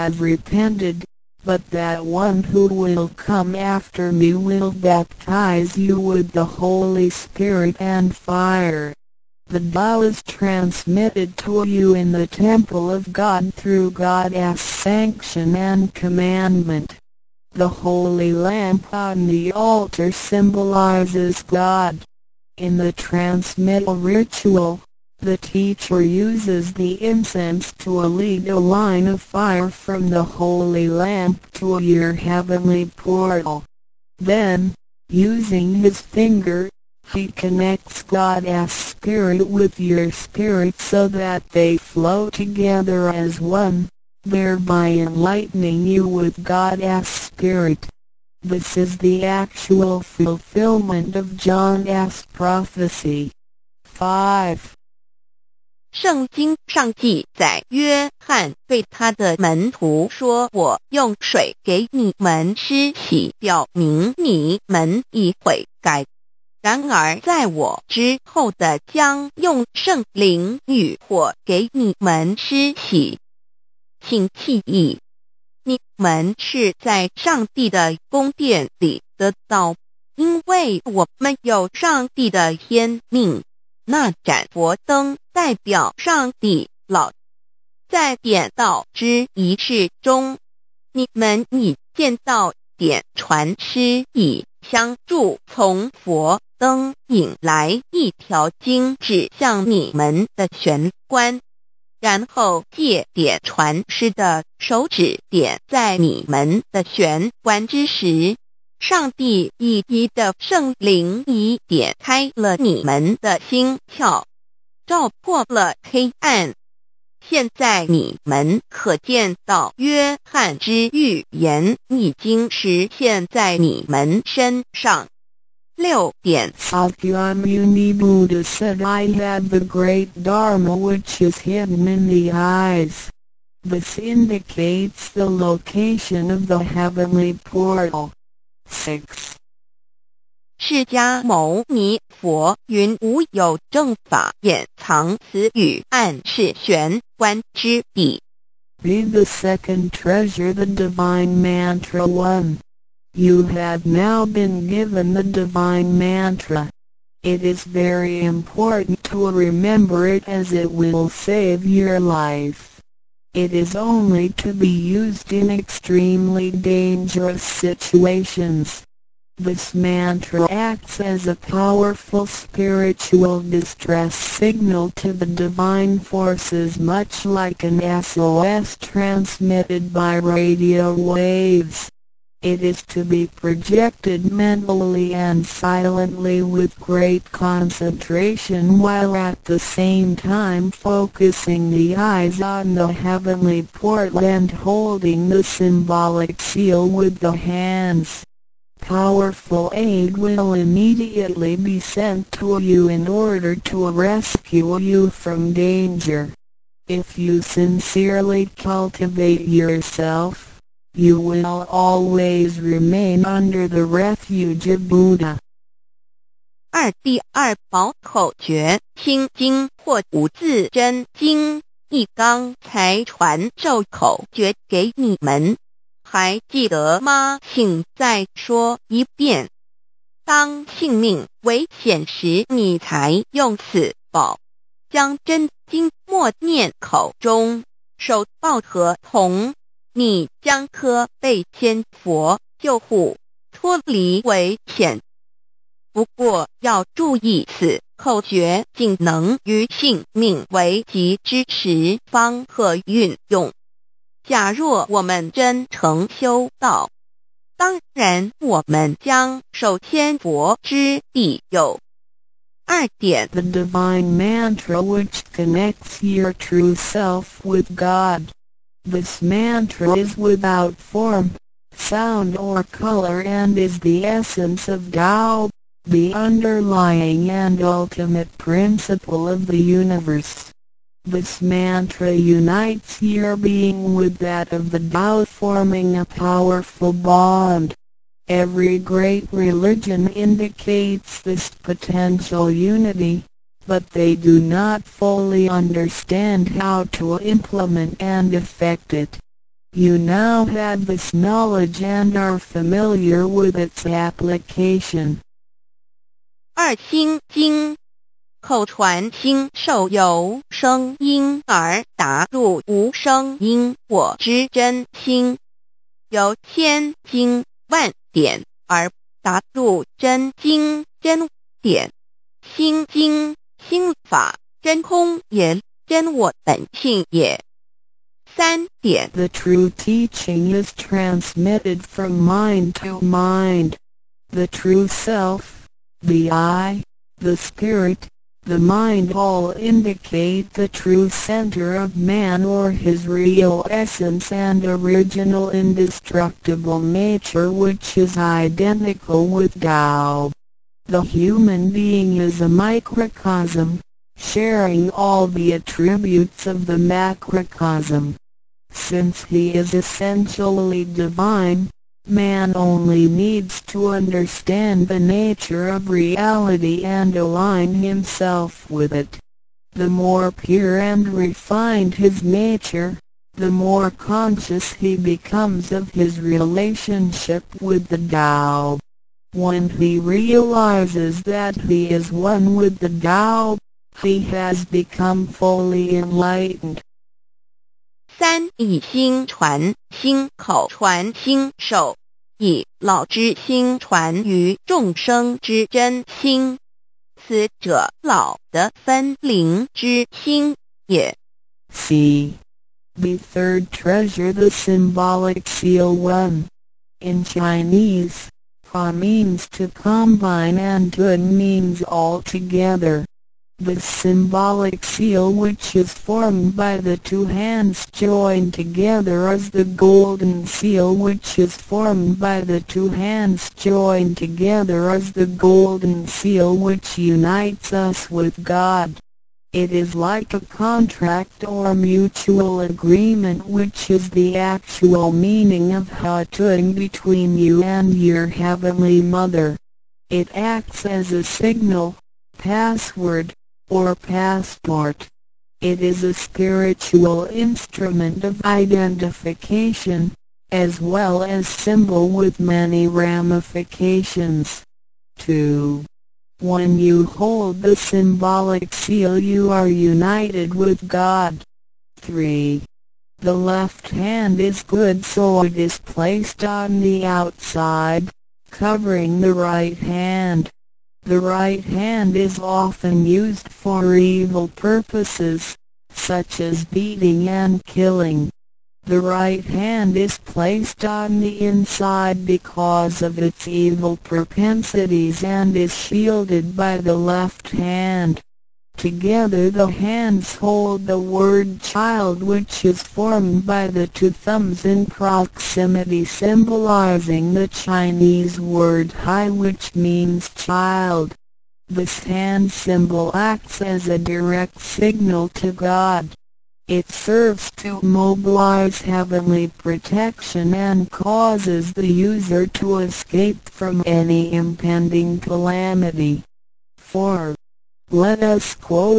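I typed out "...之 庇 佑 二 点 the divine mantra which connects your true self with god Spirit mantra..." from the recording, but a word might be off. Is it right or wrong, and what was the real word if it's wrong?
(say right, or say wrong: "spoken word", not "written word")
wrong: "This", not "Spirit".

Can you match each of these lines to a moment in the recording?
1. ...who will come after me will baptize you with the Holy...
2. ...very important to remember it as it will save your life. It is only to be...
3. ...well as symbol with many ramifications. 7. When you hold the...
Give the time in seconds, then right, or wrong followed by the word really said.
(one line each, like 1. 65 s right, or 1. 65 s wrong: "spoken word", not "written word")
1. 2 s right
2. 157 s right
3. 450 s wrong: "2", not "7".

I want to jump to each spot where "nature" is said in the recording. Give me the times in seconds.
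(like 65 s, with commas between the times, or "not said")
346 s, 364 s, 372 s.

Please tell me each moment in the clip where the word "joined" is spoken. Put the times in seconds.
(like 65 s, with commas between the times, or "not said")
417 s, 423 s.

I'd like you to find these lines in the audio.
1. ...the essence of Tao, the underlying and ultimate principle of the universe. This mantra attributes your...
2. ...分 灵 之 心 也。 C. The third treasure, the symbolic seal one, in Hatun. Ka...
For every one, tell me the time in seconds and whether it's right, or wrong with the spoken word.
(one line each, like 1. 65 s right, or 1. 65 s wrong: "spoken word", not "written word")
1. 273 s wrong: "unites", not "attributes"
2. 398 s wrong: "Chinese", not "Hatun".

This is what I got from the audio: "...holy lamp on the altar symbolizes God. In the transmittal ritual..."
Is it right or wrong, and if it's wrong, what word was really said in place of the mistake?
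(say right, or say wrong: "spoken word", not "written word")
right.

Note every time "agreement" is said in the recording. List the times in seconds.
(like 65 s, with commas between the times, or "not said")
432 s.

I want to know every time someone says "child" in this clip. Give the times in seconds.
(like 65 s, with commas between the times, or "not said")
491 s, 500 s.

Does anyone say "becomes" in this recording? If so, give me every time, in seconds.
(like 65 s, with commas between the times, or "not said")
374 s, 384 s.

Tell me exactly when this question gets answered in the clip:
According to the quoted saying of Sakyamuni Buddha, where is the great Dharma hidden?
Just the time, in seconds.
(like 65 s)
131 s.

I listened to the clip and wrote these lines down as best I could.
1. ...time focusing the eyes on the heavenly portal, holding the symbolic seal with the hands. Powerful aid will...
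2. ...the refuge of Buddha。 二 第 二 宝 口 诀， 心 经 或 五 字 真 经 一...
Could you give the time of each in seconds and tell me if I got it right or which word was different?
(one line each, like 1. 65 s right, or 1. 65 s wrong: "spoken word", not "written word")
1. 190 s right
2. 213 s right.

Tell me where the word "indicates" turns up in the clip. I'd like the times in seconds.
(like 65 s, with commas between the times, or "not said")
133 s, 290 s, 339 s.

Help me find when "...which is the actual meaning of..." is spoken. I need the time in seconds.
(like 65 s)
433 s.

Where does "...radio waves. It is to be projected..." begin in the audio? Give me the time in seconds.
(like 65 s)
180 s.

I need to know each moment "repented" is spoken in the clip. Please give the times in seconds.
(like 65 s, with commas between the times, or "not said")
0 s.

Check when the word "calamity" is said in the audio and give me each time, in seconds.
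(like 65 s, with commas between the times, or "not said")
515 s.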